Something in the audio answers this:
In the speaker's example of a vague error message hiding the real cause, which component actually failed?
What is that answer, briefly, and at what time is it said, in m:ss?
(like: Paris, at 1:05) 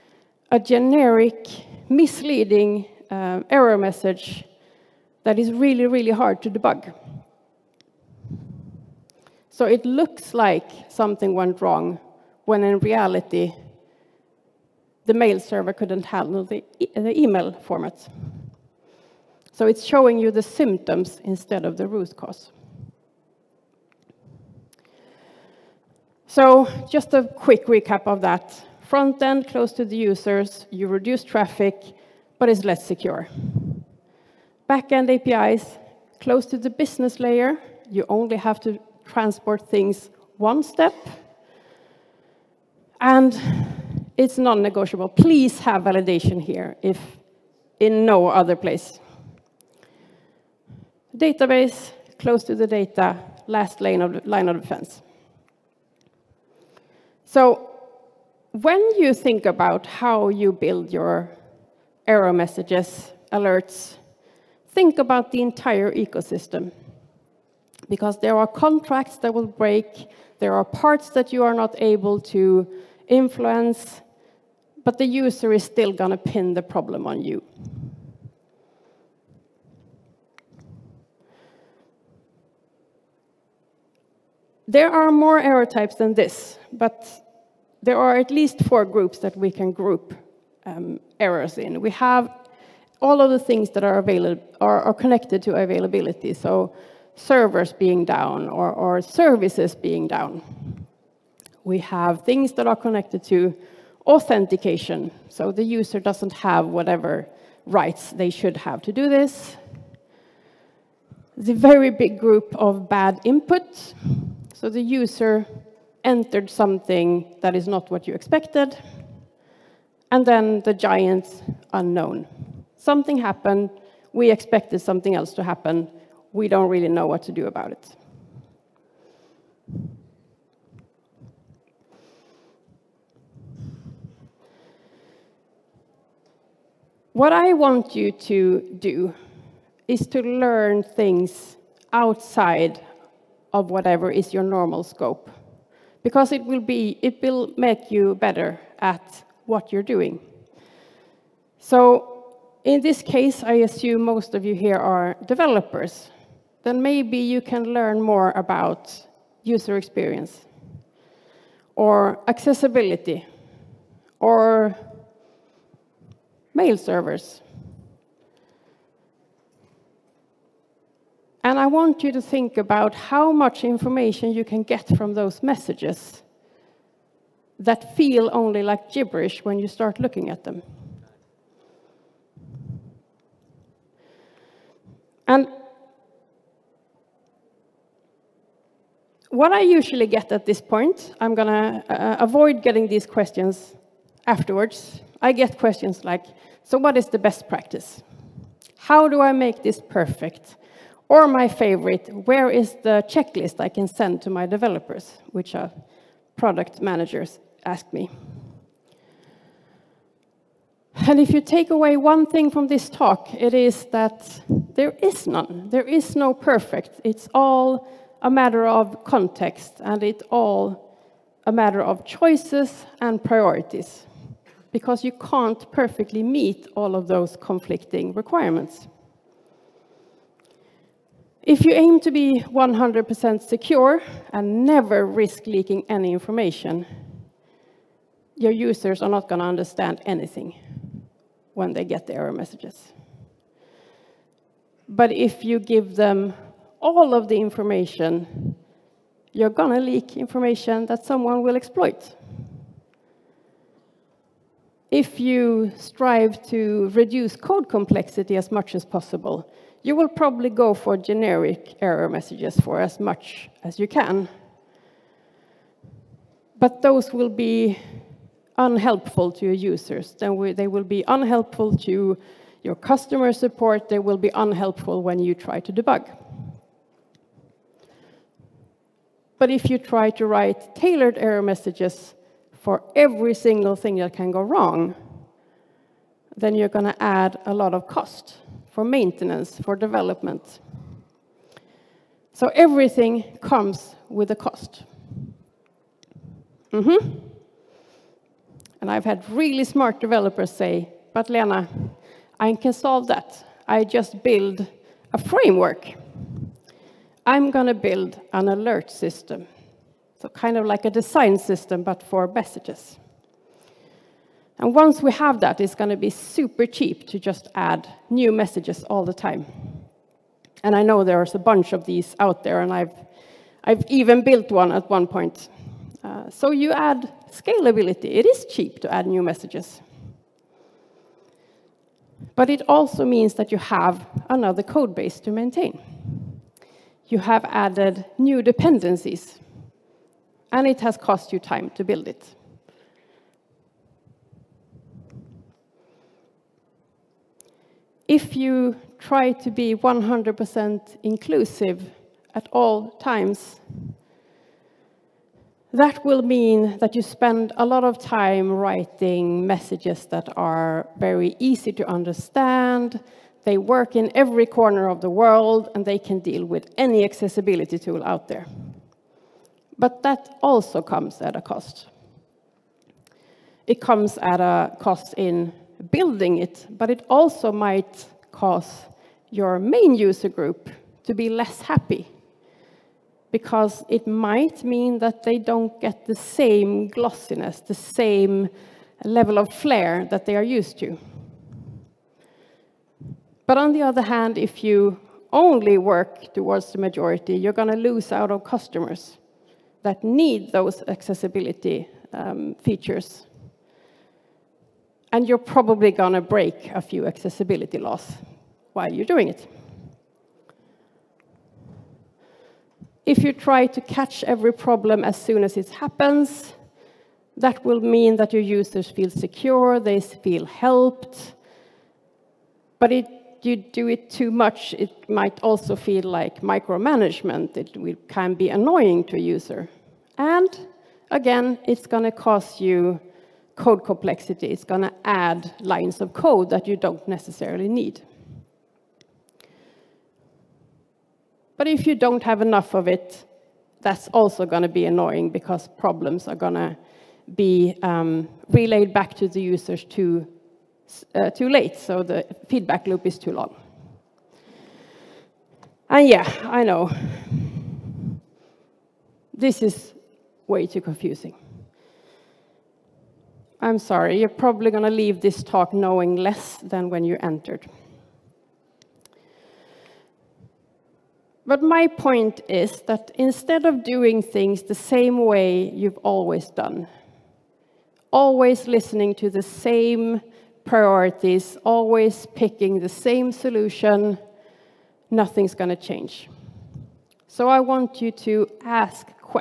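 mail server, at 0:15.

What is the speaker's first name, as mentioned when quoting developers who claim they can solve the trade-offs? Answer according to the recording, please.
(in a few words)
Lena.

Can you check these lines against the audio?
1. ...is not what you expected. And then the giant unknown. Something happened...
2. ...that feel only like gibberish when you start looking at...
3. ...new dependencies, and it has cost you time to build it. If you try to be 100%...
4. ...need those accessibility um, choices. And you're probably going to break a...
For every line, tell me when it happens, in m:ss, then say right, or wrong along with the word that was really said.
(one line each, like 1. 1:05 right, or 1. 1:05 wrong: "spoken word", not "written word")
1. 1:57 right
2. 2:57 right
3. 5:38 right
4. 6:40 wrong: "features", not "choices".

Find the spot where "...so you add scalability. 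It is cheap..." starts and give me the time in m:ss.
5:26.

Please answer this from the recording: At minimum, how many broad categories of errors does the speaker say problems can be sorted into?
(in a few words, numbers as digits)
4.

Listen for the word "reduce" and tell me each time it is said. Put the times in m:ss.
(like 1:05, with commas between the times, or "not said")
0:30, 4:16.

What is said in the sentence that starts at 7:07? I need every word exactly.
It can be annoying to a user.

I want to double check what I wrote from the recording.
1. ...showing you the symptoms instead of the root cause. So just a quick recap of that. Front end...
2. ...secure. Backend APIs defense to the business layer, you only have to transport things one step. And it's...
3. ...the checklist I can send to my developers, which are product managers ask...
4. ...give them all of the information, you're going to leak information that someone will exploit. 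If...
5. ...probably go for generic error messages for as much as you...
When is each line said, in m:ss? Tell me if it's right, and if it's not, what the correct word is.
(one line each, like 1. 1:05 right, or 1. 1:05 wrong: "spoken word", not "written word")
1. 0:19 right
2. 0:32 wrong: "close", not "defense"
3. 3:22 right
4. 4:05 right
5. 4:20 right.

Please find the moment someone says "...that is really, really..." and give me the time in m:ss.
0:05.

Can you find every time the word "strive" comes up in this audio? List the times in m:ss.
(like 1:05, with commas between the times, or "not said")
4:15.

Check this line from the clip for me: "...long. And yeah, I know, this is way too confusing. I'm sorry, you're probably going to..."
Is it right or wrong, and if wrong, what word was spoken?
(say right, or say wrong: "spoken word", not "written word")
right.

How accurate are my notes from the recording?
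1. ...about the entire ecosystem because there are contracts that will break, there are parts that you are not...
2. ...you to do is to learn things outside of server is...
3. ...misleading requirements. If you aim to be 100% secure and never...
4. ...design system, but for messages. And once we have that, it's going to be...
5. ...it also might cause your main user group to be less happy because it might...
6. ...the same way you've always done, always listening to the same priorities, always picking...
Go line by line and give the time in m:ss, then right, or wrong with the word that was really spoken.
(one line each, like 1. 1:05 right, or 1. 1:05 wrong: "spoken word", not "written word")
1. 1:04 right
2. 2:17 wrong: "whatever", not "server"
3. 3:47 wrong: "conflicting", not "misleading"
4. 5:10 right
5. 6:16 right
6. 7:54 right.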